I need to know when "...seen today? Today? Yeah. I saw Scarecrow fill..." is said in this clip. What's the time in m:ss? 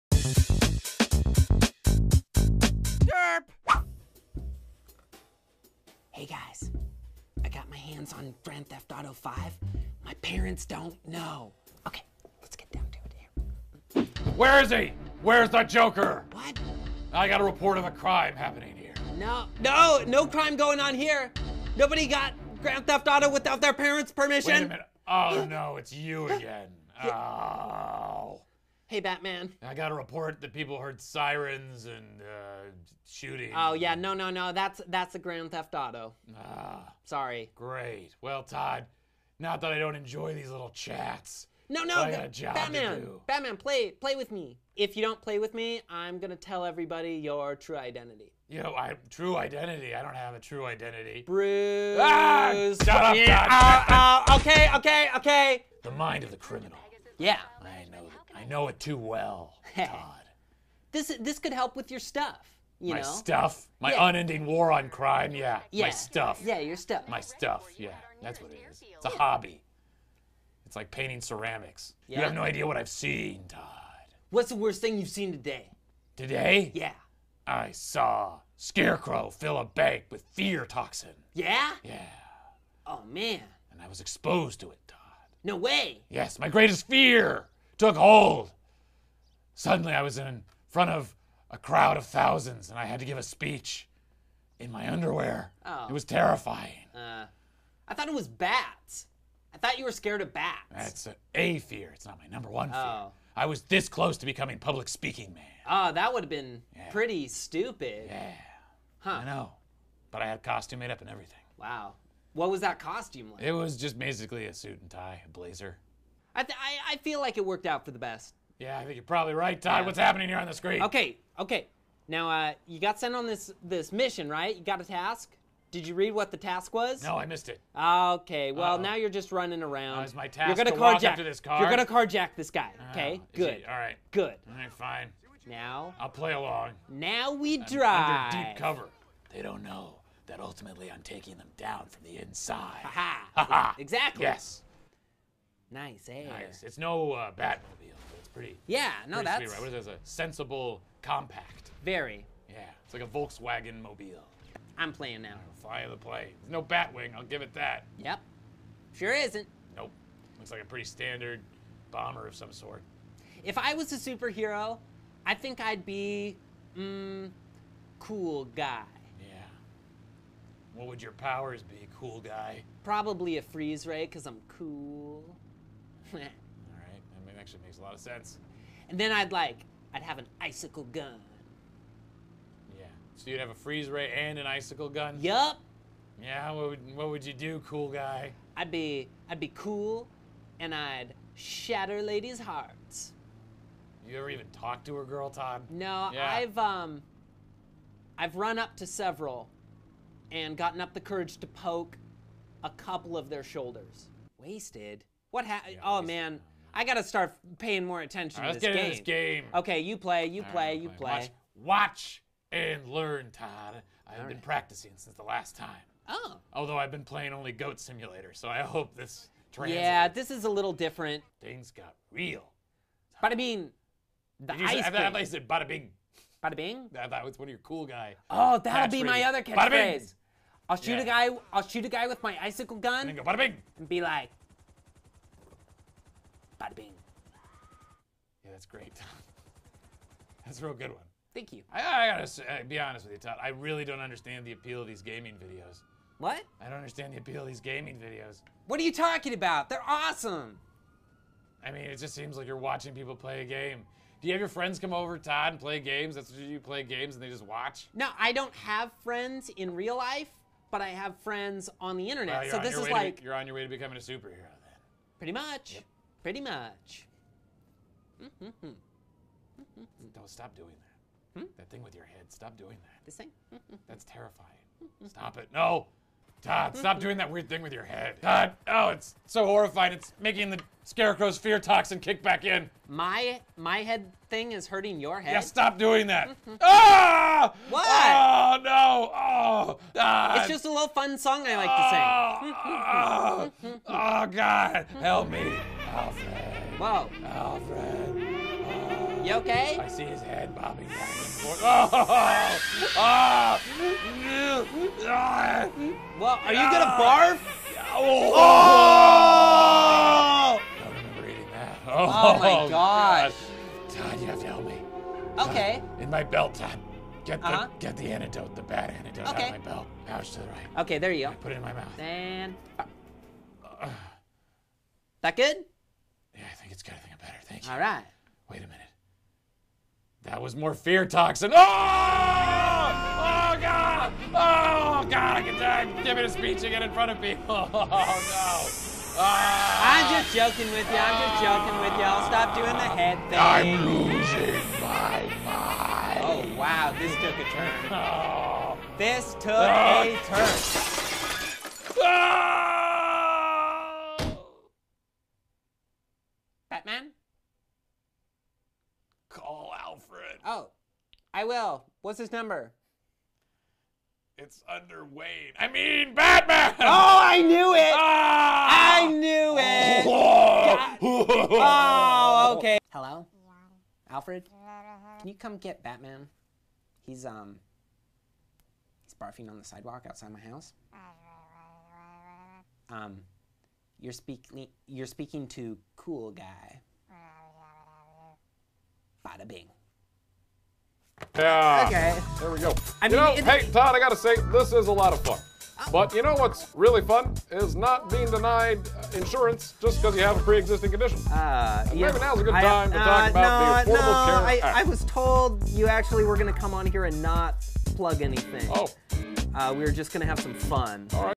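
1:15.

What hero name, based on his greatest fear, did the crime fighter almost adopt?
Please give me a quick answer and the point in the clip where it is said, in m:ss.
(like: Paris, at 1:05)
Public Speaking Man, at 1:44.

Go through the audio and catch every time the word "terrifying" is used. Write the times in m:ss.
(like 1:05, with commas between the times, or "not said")
1:36, 4:34.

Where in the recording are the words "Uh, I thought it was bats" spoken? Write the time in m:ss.
1:36.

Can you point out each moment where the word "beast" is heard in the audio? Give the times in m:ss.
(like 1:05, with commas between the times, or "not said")
not said.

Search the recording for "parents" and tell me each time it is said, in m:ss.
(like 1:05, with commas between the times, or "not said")
0:10, 0:23.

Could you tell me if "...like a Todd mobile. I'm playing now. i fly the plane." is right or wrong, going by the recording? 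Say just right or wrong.
wrong.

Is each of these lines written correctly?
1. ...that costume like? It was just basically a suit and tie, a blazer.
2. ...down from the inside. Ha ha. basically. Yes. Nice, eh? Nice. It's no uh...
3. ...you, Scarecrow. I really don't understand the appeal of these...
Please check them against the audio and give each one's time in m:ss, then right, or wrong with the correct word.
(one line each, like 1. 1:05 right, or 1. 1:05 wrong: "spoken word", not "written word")
1. 1:52 right
2. 2:21 wrong: "exactly", not "basically"
3. 4:03 wrong: "Todd", not "Scarecrow".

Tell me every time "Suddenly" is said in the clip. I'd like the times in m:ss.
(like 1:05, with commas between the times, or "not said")
1:29.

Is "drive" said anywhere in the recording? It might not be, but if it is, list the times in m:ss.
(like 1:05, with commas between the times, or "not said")
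2:17.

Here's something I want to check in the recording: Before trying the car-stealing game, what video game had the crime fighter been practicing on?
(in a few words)
Goat Simulator.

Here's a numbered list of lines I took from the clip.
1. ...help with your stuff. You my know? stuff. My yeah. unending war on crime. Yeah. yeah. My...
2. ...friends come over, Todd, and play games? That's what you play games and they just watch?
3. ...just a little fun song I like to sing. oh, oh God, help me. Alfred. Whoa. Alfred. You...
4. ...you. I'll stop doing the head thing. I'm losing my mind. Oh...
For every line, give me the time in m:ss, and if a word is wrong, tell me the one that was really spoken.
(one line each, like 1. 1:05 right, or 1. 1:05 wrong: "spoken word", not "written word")
1. 1:01 right
2. 4:14 right
3. 4:50 right
4. 5:41 right.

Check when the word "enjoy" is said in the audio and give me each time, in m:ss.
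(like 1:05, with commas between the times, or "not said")
0:39.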